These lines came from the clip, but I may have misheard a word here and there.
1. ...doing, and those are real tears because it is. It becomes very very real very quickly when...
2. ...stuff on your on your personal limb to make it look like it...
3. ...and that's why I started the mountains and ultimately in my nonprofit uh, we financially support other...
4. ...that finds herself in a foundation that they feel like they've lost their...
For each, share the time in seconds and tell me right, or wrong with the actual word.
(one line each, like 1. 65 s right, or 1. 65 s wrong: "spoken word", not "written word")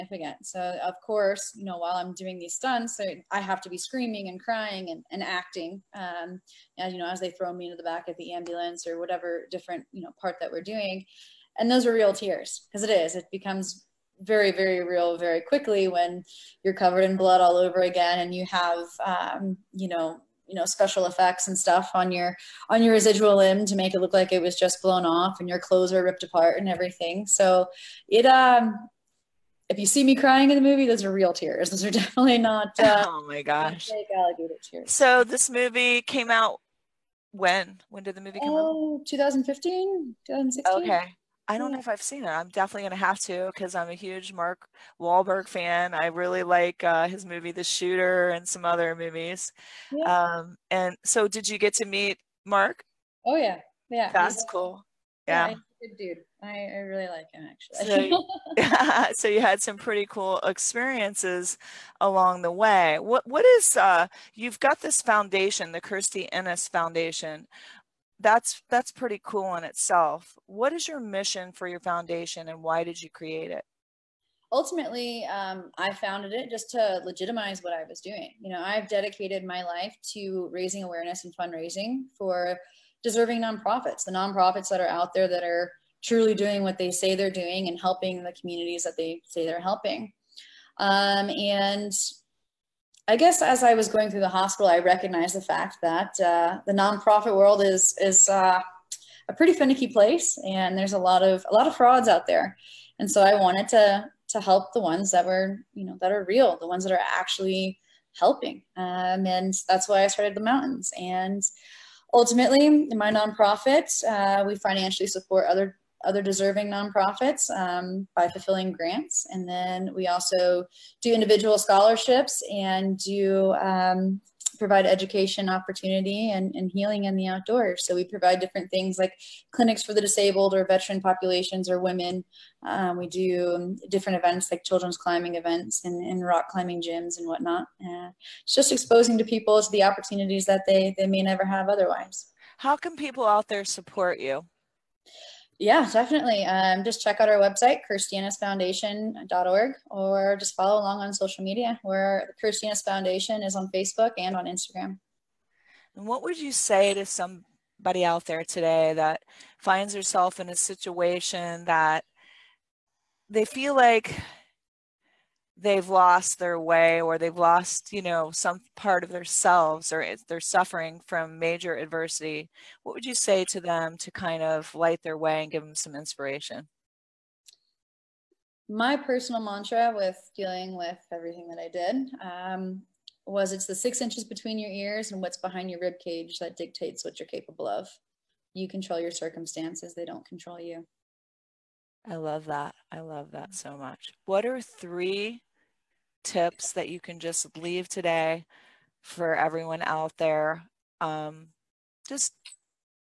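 1. 10 s right
2. 21 s wrong: "residual", not "personal"
3. 109 s right
4. 158 s wrong: "situation", not "foundation".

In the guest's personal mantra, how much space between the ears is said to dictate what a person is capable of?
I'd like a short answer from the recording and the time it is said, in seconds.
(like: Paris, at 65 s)
6 inches, at 183 s.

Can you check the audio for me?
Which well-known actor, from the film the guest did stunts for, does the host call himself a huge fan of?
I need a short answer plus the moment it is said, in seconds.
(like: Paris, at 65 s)
Mark Wahlberg, at 44 s.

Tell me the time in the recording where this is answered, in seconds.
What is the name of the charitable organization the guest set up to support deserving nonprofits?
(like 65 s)
65 s.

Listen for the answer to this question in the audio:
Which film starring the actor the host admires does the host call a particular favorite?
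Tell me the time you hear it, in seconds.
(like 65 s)
47 s.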